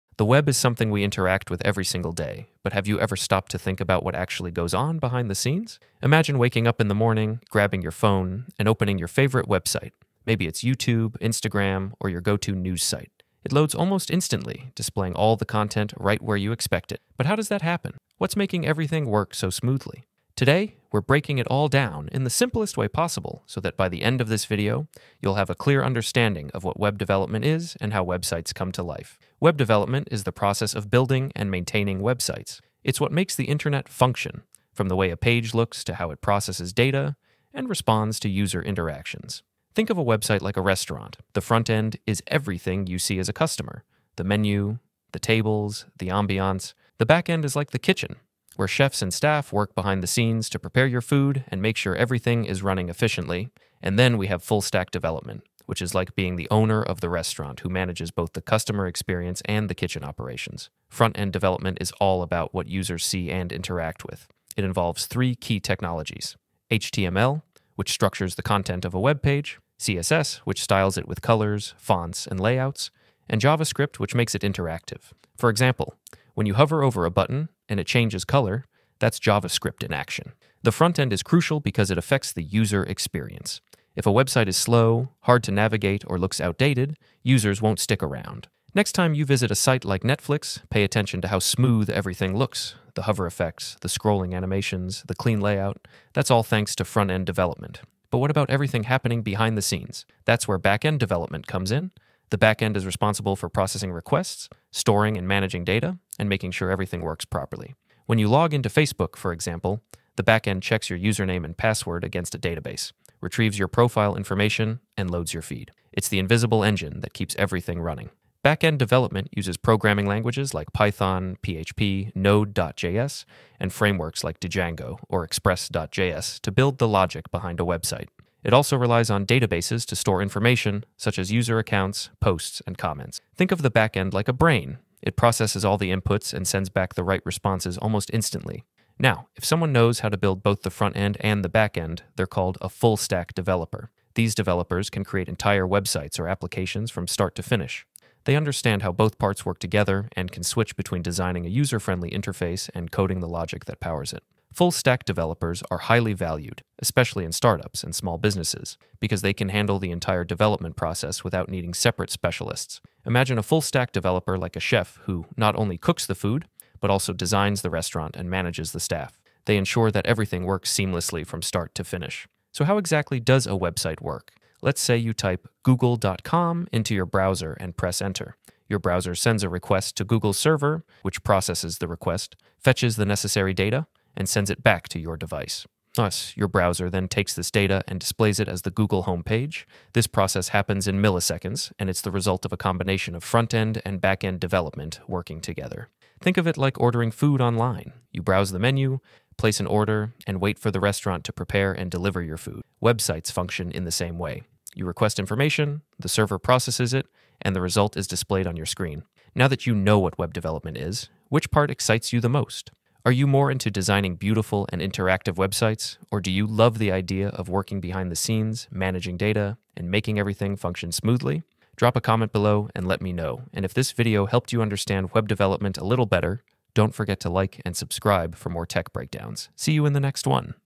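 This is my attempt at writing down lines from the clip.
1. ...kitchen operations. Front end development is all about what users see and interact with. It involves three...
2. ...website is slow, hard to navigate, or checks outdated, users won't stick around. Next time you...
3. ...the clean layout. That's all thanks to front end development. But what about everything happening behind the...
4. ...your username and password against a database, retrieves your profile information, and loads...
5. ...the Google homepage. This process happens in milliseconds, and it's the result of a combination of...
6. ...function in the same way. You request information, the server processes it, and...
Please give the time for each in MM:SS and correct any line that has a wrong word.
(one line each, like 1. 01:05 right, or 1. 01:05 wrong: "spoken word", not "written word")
1. 00:59 right
2. 01:24 wrong: "looks", not "checks"
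3. 01:35 right
4. 01:50 right
5. 03:08 right
6. 03:23 right.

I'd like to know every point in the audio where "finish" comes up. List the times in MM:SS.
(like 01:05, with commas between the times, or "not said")
02:27, 02:51.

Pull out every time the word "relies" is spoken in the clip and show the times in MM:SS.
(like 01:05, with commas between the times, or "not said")
02:08.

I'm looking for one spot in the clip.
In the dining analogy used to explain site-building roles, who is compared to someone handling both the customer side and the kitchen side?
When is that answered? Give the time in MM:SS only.
00:56.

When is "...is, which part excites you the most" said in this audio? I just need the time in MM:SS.
03:30.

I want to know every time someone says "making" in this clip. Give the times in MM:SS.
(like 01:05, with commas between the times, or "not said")
00:18, 01:46, 03:39.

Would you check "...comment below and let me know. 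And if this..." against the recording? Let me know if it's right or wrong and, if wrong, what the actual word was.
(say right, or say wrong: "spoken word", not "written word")
right.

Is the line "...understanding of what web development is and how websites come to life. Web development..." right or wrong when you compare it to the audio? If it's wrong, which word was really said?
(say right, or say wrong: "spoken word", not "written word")
right.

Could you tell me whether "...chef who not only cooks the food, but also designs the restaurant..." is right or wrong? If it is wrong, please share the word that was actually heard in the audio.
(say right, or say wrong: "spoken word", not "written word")
right.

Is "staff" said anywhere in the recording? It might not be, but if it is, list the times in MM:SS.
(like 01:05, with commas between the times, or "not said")
00:49, 02:48.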